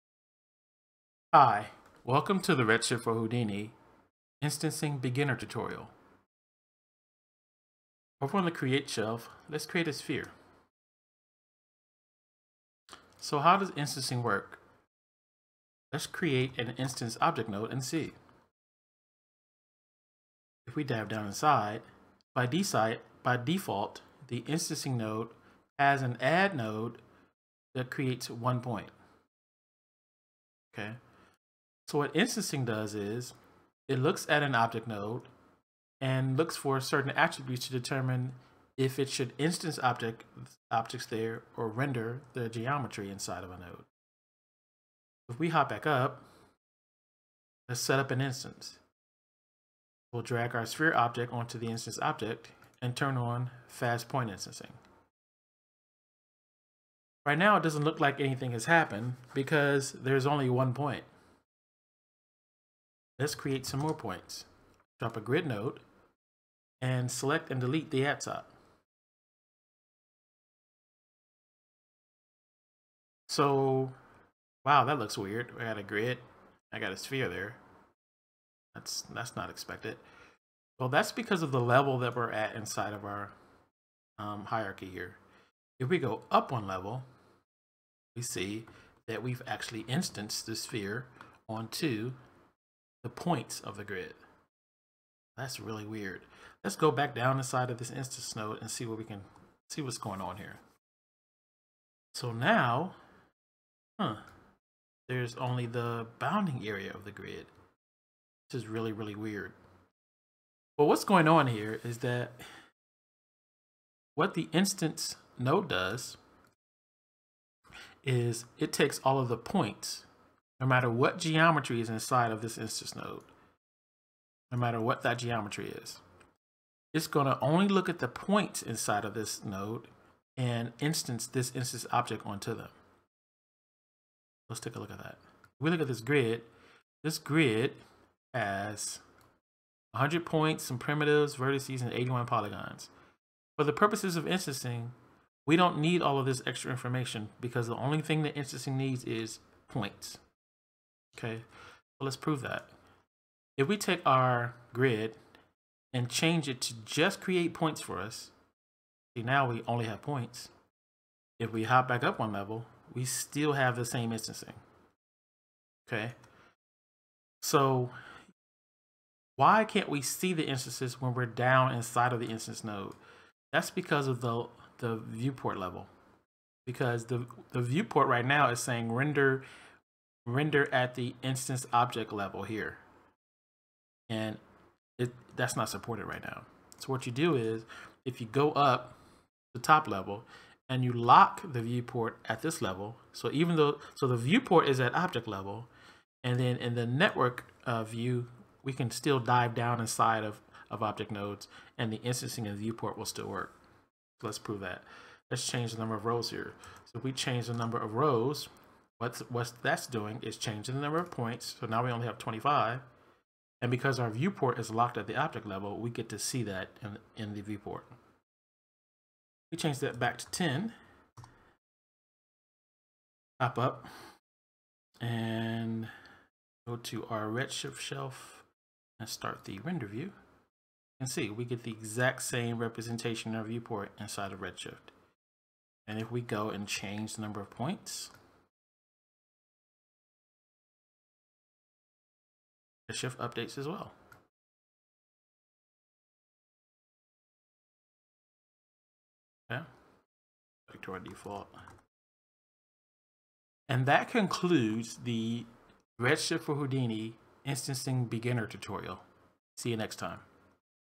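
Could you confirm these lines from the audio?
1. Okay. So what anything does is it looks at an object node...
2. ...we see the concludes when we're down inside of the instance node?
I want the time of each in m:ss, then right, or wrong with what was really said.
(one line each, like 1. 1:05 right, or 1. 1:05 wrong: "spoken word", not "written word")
1. 0:30 wrong: "instancing", not "anything"
2. 2:49 wrong: "instances", not "concludes".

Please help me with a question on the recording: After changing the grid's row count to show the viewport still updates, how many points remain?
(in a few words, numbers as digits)
25.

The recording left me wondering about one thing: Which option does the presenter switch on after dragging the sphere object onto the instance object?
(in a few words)
fast point instancing.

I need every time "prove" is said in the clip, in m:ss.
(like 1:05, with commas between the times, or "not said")
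2:32, 3:24.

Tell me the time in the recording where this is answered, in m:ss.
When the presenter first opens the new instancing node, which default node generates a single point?
0:26.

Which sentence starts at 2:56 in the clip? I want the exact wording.
Because the, the viewport right now is saying render render at the instance object level here.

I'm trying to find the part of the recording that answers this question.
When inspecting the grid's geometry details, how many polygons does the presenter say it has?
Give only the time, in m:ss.
2:21.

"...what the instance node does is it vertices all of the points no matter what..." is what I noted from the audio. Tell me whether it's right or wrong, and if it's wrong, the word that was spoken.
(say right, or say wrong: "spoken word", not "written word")
wrong: "takes", not "vertices".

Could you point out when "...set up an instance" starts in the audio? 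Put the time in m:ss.
0:47.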